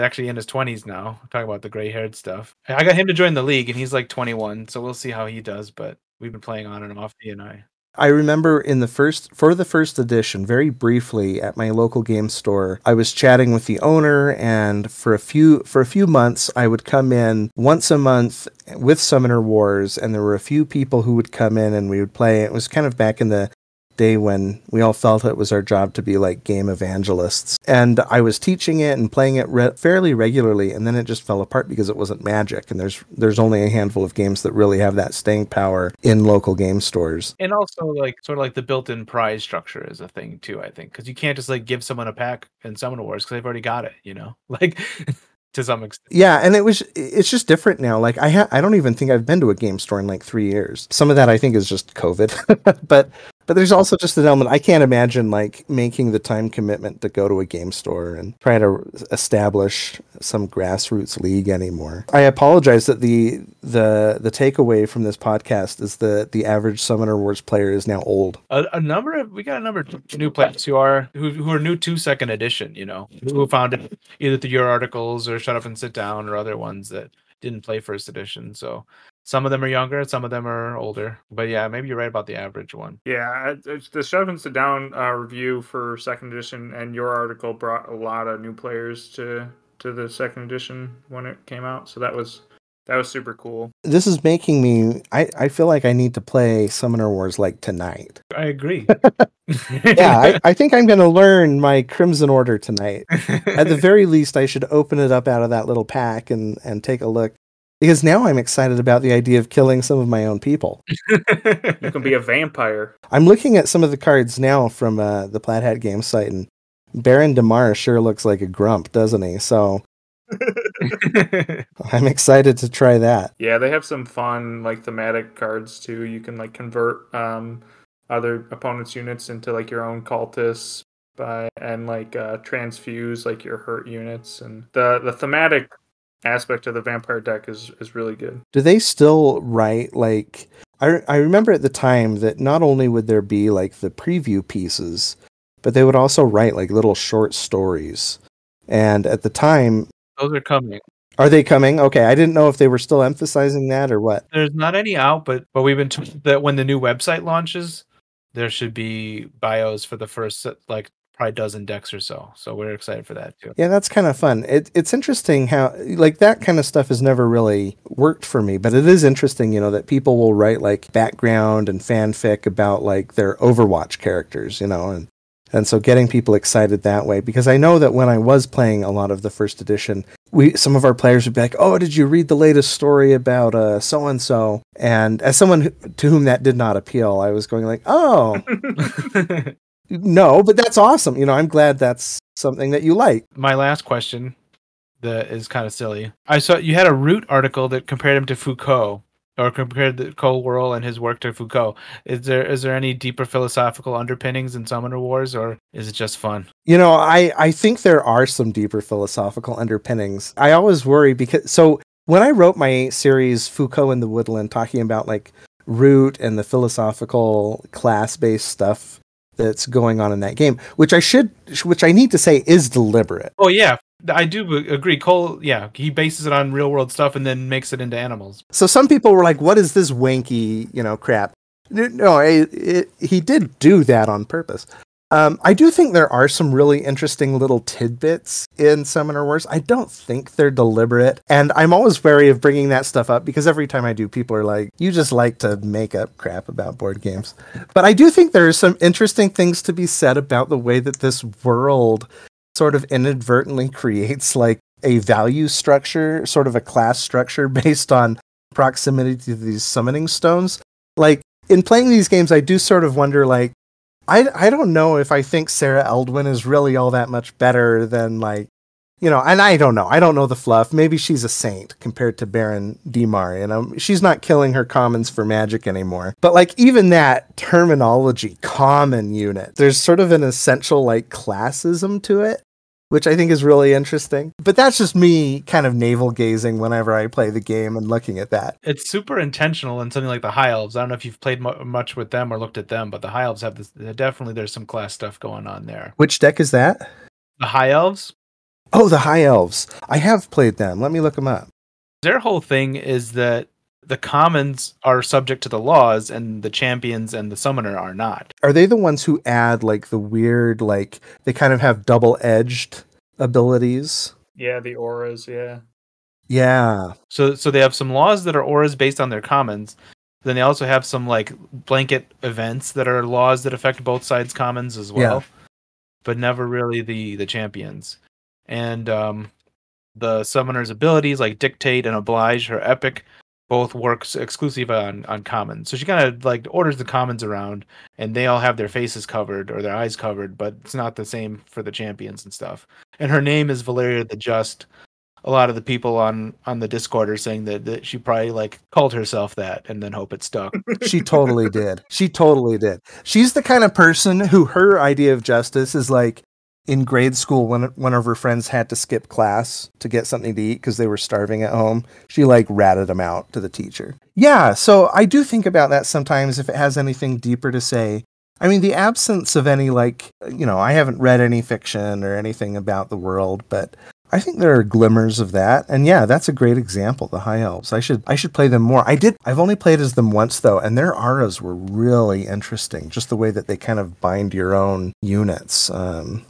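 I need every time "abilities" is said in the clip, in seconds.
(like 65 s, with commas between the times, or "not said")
313 s, 330 s.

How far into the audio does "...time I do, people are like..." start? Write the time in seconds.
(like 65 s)
243 s.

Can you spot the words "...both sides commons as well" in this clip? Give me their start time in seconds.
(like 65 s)
323 s.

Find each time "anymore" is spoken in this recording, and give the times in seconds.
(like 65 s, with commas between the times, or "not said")
61 s, 275 s.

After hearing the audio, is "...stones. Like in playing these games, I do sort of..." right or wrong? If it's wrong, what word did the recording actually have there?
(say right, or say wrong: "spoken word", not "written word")
right.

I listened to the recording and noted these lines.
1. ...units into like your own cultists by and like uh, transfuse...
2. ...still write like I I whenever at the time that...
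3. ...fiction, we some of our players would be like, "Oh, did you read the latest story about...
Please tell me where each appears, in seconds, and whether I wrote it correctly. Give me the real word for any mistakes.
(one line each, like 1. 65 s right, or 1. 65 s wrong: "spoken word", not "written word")
1. 128 s right
2. 138 s wrong: "remember", not "whenever"
3. 179 s wrong: "edition", not "fiction".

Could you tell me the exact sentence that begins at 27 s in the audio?
And I was teaching it and playing it re- fairly regularly, and then it just fell apart because it wasn't magic.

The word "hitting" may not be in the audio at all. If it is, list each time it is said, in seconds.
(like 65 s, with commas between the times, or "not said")
not said.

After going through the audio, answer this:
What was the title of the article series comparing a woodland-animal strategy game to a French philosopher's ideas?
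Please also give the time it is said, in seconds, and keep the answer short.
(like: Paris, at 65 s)
Foucault in the Woodland, at 213 s.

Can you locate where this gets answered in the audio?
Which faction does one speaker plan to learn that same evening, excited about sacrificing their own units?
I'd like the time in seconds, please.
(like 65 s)
101 s.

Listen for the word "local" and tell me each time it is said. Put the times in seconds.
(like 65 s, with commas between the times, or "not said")
11 s, 36 s.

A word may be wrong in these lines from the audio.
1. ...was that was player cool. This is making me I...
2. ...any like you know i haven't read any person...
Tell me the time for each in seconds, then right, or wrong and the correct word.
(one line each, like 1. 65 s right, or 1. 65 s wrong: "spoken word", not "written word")
1. 92 s wrong: "super", not "player"
2. 369 s wrong: "fiction", not "person".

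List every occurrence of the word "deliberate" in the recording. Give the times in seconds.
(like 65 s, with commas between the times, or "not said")
222 s, 240 s.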